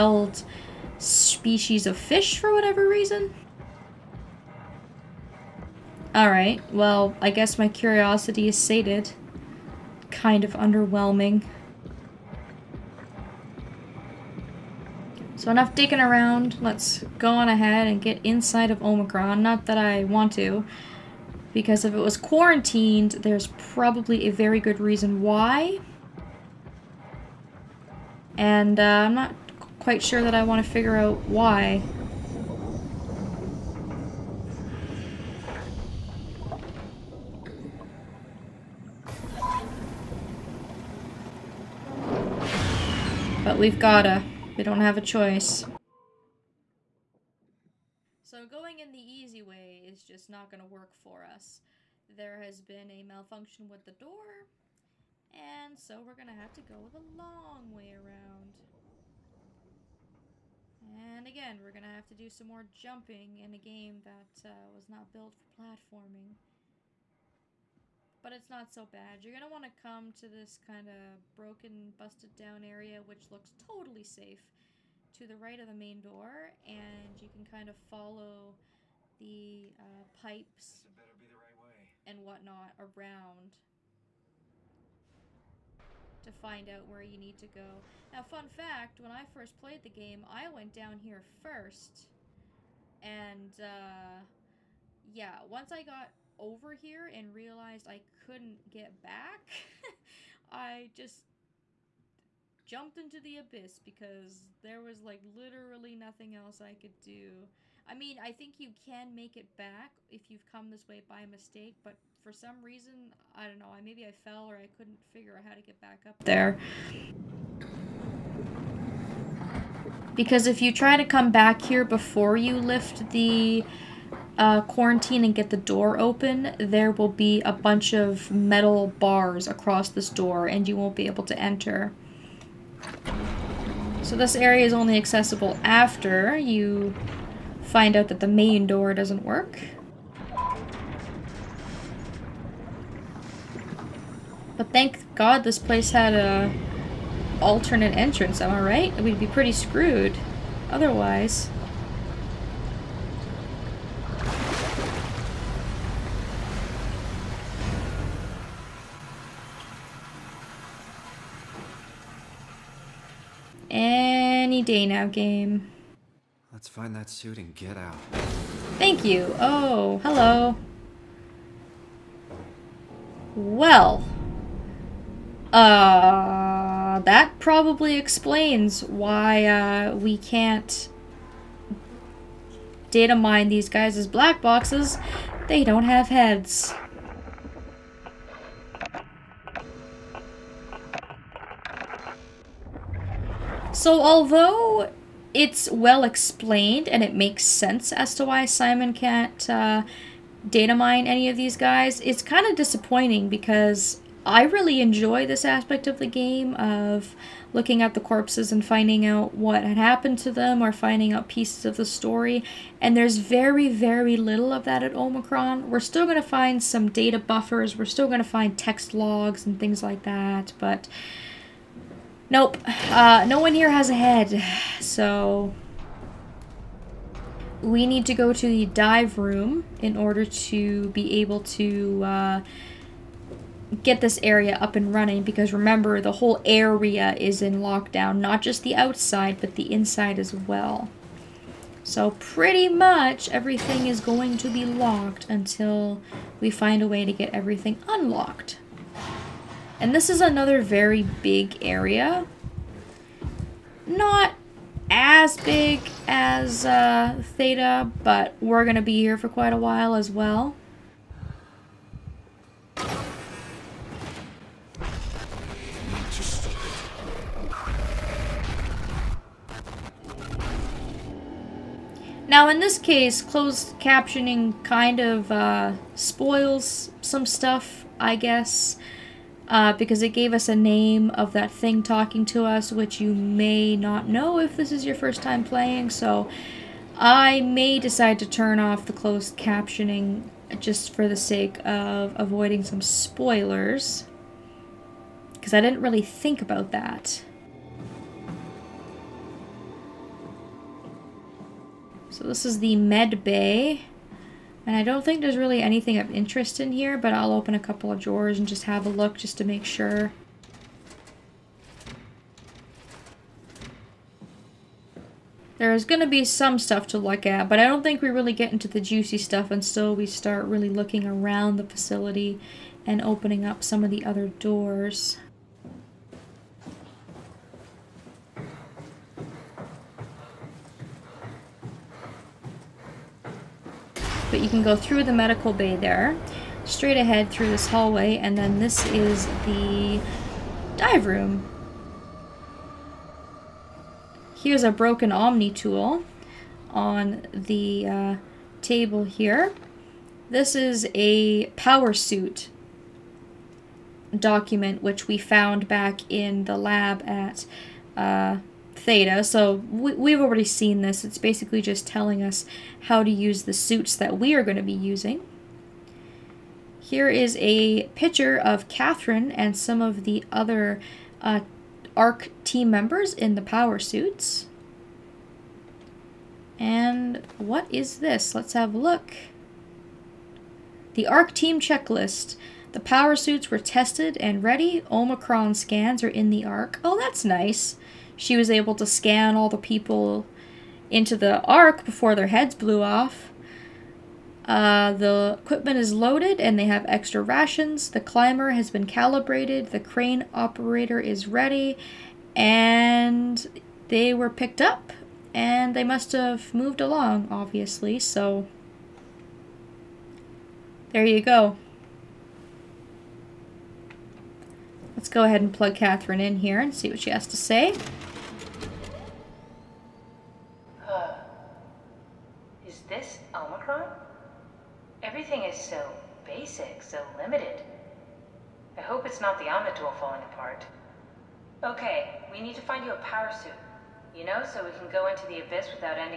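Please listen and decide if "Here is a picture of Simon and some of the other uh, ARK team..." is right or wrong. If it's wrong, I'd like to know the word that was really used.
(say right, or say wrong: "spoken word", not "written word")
wrong: "Catherine", not "Simon".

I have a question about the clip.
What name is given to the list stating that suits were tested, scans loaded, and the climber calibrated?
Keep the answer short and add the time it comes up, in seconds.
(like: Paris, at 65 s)
The ARK team checklist, at 380 s.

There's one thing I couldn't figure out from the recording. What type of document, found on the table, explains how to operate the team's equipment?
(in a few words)
a power suit document.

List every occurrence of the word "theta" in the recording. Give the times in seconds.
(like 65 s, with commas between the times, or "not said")
257 s, 358 s.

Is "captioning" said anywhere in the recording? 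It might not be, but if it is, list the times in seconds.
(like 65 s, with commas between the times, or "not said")
273 s, 289 s.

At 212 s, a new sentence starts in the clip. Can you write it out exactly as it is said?
And there's very, very little of that at Omicron.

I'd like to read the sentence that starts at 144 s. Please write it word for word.
But thank god this place had a alternate entrance, am I right?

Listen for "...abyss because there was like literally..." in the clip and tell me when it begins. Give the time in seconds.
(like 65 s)
103 s.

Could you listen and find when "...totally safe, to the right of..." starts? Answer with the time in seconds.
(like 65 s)
73 s.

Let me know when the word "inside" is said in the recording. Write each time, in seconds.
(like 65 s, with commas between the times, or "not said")
18 s, 239 s.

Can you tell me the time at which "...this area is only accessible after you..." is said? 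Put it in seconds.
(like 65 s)
134 s.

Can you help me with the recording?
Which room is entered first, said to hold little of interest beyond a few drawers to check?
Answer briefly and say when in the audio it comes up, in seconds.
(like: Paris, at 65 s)
the med bay, at 302 s.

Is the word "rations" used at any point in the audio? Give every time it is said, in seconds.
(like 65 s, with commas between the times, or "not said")
397 s.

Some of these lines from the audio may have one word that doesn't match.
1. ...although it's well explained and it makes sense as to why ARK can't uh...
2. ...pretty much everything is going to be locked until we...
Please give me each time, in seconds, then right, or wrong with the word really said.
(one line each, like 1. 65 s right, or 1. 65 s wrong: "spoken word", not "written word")
1. 193 s wrong: "Simon", not "ARK"
2. 242 s right.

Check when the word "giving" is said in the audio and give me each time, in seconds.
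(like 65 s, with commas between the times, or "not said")
not said.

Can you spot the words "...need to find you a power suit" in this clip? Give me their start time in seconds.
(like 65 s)
432 s.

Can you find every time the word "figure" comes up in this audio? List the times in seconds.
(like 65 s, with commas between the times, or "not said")
30 s, 115 s.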